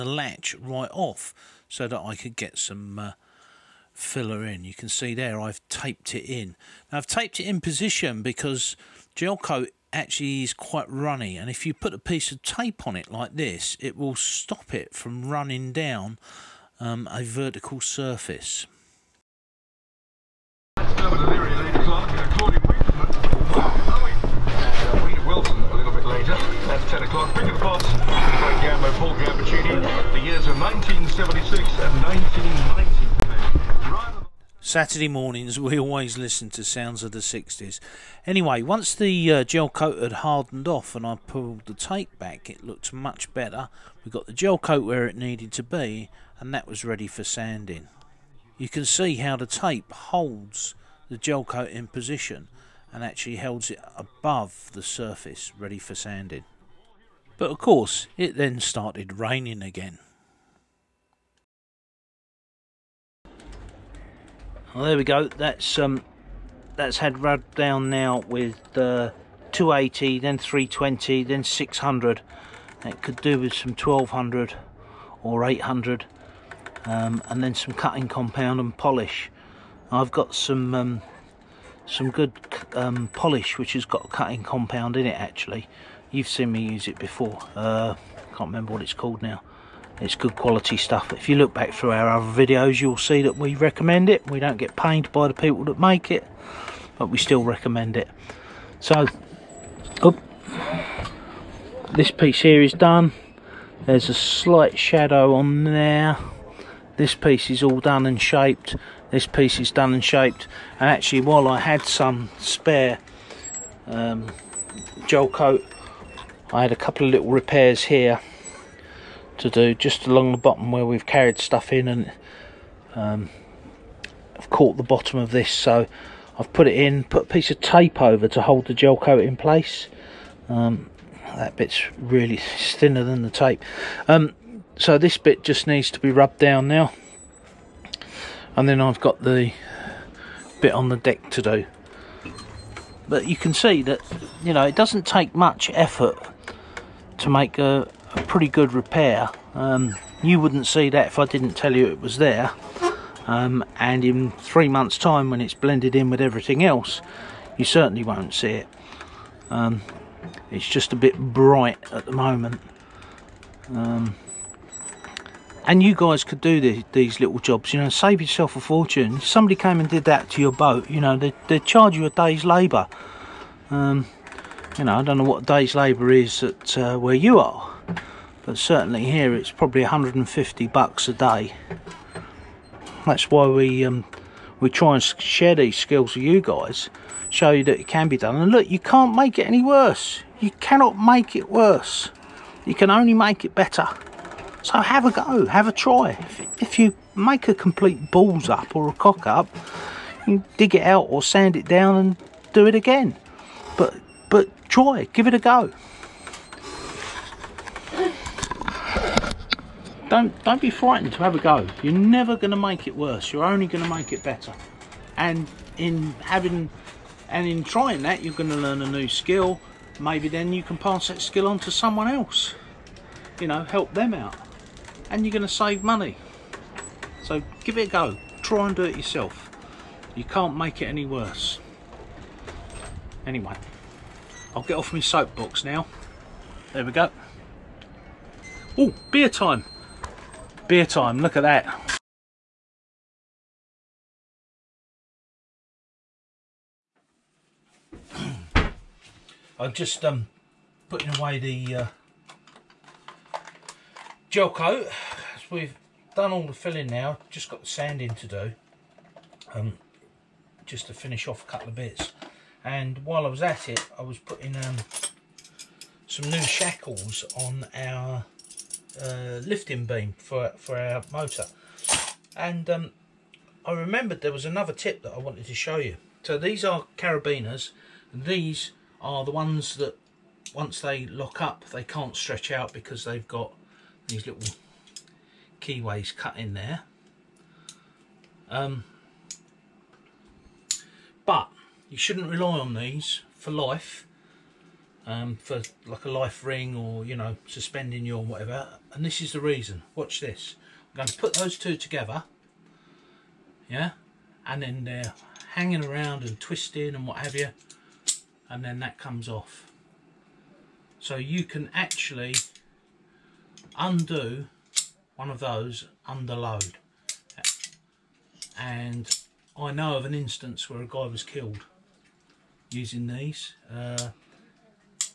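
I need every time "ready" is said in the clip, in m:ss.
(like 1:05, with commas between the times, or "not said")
0:46, 0:55.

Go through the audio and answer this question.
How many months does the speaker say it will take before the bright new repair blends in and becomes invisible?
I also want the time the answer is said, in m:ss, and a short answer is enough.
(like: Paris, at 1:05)
3, at 2:34.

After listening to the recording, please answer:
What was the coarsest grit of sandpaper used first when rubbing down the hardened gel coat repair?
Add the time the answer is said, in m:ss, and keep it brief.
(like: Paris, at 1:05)
280, at 1:09.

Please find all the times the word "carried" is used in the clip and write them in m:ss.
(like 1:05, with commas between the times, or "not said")
2:01.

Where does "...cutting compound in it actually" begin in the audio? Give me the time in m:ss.
1:24.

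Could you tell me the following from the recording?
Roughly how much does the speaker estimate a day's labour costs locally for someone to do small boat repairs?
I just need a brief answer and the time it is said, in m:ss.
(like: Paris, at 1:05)
150 bucks, at 2:59.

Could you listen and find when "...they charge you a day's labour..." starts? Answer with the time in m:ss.
2:51.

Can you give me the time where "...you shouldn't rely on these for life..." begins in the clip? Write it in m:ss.
4:51.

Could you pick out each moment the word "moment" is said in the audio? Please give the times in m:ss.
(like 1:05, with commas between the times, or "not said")
2:42.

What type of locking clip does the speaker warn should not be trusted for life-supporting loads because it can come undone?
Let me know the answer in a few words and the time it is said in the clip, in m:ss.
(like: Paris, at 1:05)
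carabiners, at 4:36.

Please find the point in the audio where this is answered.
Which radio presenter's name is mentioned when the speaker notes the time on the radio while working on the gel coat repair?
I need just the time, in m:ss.
0:28.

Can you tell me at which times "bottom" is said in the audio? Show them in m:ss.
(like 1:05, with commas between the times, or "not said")
2:00, 2:04.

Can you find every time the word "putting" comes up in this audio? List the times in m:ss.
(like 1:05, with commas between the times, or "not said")
4:10, 4:24.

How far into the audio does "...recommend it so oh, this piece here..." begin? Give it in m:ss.
1:37.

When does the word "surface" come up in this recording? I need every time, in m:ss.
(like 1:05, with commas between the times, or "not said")
0:17, 0:54.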